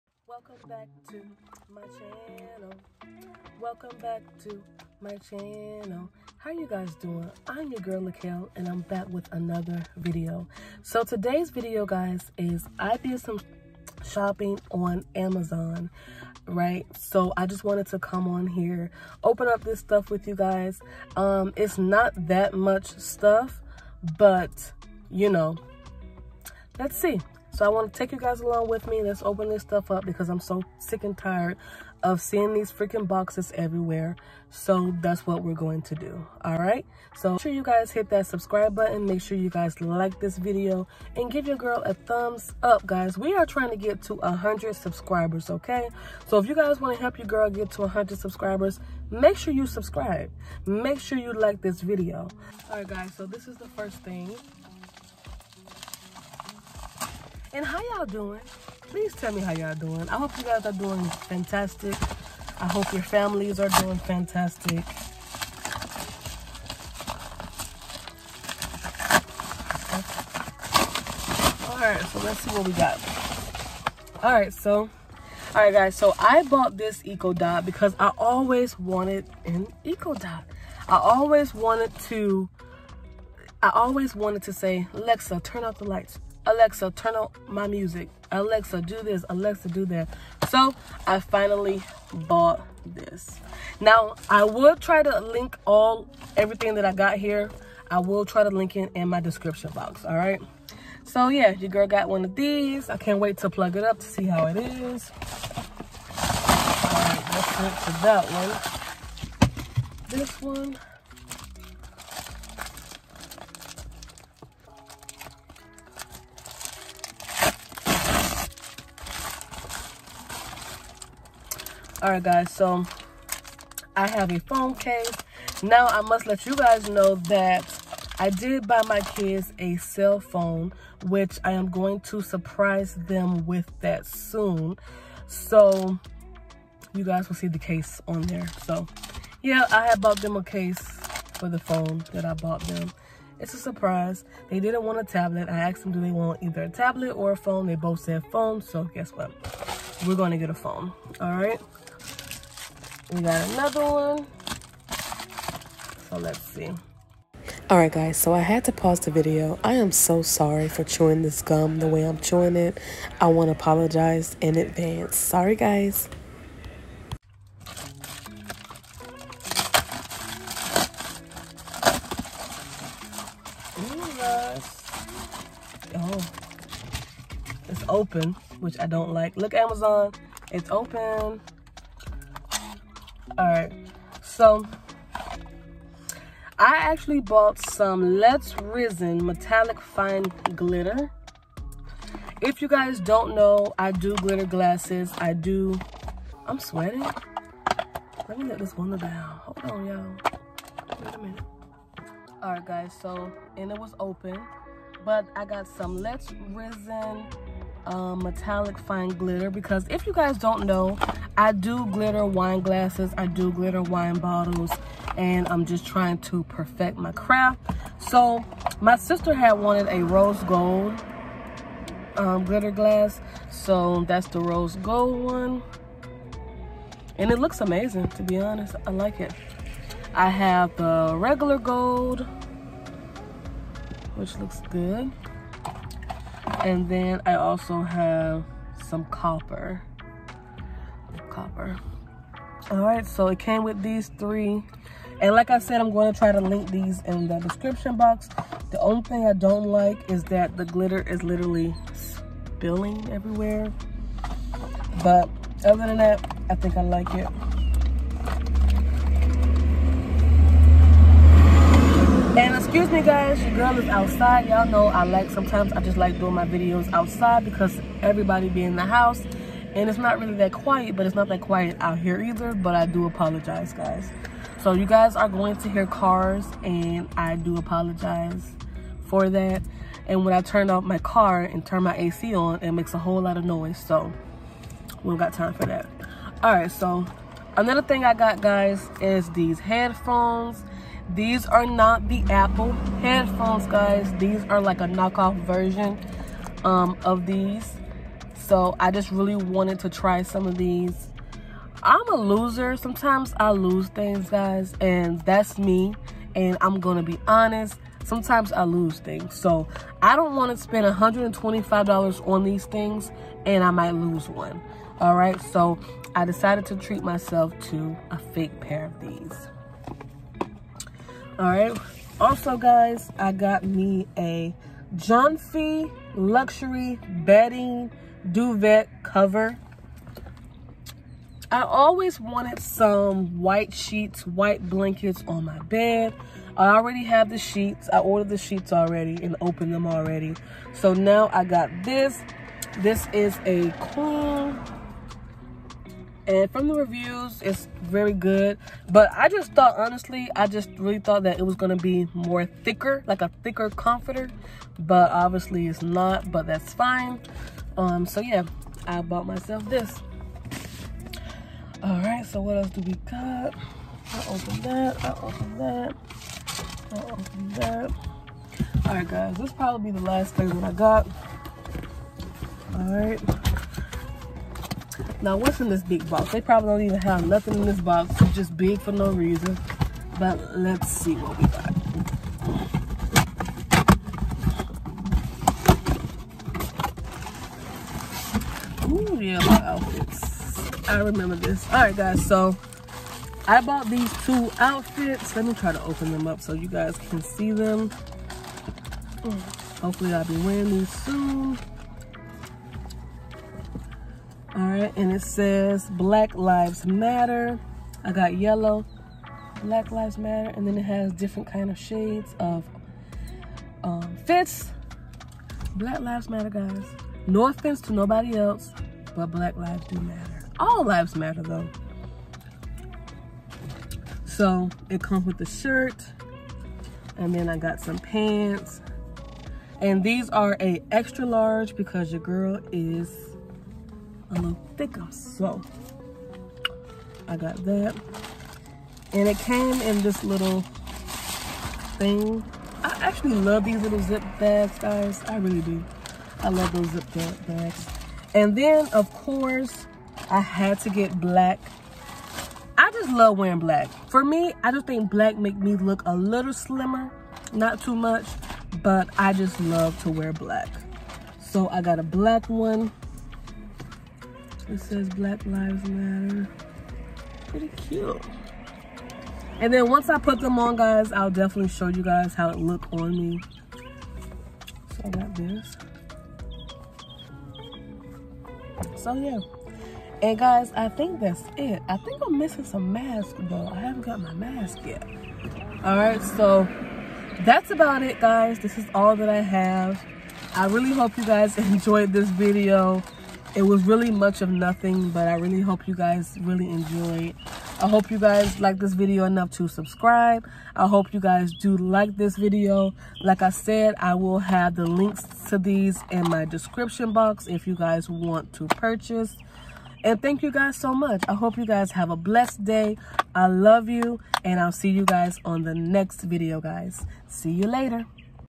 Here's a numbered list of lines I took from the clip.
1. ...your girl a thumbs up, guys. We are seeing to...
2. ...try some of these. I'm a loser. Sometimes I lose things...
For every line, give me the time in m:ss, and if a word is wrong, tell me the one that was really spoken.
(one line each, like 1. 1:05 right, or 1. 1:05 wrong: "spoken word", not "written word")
1. 0:41 wrong: "trying", not "seeing"
2. 4:59 right.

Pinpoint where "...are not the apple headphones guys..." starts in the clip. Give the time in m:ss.
4:51.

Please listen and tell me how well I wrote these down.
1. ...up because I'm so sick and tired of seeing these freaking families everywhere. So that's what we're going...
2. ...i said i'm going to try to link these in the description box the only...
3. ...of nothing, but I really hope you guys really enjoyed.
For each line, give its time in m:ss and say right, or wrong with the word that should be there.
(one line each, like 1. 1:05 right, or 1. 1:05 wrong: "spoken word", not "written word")
1. 0:29 wrong: "boxes", not "families"
2. 4:05 right
3. 8:14 right.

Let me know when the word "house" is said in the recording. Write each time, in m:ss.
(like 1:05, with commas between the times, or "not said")
4:28.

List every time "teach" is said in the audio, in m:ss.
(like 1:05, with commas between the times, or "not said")
not said.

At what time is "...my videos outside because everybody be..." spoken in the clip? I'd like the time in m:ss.
4:26.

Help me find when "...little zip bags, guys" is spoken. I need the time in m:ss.
7:23.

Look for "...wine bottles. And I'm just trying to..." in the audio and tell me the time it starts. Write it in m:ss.
3:33.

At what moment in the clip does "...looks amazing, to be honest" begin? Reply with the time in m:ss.
3:47.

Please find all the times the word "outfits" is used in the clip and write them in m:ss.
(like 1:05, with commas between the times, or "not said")
6:29, 6:34.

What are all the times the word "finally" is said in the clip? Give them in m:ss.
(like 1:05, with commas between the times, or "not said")
1:31.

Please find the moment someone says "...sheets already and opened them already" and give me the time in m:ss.
5:38.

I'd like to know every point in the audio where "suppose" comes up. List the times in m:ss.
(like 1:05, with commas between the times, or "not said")
not said.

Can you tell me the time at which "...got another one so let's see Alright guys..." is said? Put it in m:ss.
2:33.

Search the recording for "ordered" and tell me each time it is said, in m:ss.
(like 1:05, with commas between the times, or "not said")
5:37.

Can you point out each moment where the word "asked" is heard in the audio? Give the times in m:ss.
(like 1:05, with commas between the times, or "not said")
2:25.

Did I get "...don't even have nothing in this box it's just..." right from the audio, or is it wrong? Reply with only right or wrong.
right.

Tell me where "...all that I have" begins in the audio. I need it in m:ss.
8:08.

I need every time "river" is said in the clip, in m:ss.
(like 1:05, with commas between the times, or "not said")
not said.